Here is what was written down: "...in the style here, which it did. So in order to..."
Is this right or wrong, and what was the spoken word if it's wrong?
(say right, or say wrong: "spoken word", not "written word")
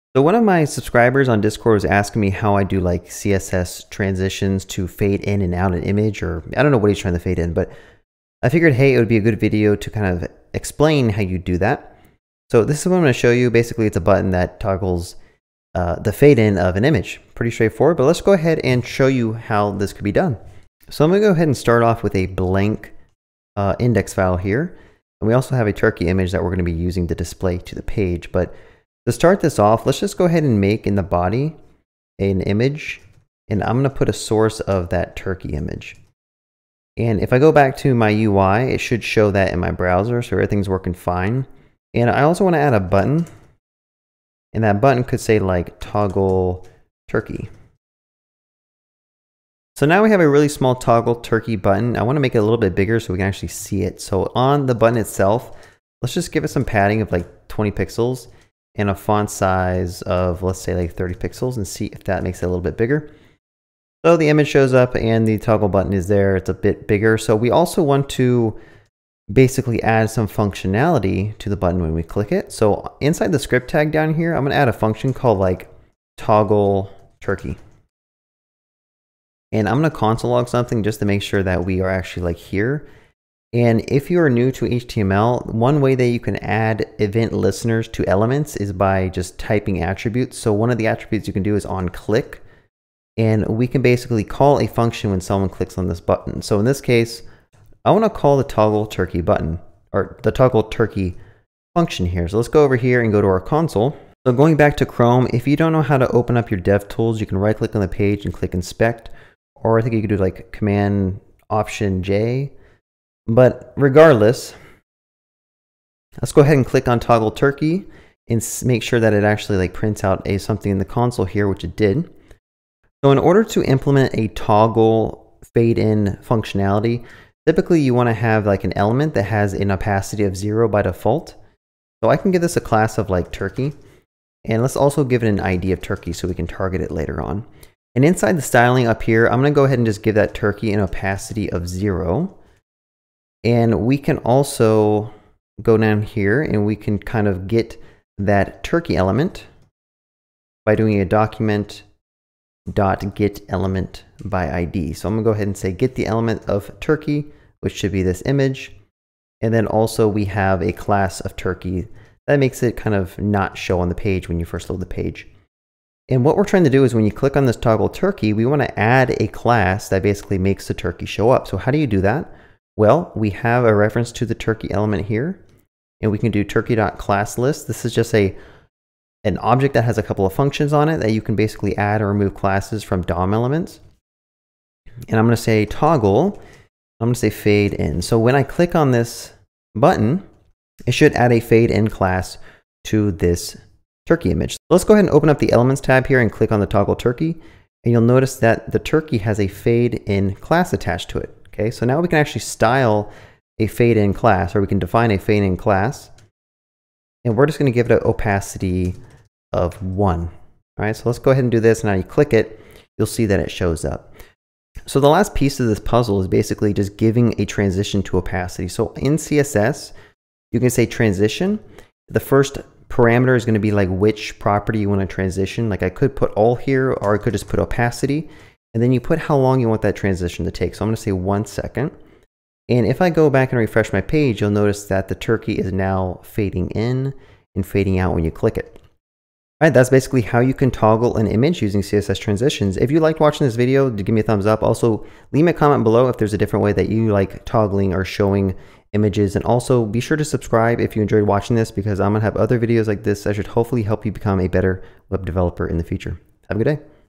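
wrong: "console", not "style".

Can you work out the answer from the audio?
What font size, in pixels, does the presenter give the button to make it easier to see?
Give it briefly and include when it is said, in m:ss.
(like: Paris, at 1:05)
30 pixels, at 1:00.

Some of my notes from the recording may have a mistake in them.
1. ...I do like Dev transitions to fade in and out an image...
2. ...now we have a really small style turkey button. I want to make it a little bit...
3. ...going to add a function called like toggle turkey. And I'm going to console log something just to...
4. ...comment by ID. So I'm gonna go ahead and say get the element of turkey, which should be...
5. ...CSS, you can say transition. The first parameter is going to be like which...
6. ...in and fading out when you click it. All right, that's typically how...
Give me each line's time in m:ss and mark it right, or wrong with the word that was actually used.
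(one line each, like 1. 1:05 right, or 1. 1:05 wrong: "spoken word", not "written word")
1. 0:02 wrong: "CSS", not "Dev"
2. 0:49 wrong: "toggle", not "style"
3. 1:14 right
4. 2:33 wrong: "element", not "comment"
5. 3:39 right
6. 3:56 wrong: "basically", not "typically".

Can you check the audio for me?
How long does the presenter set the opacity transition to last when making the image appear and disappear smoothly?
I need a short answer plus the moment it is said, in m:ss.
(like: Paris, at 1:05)
1 second, at 3:51.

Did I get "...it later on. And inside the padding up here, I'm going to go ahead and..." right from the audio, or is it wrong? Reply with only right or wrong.
wrong.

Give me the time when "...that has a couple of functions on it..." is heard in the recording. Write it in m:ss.
2:59.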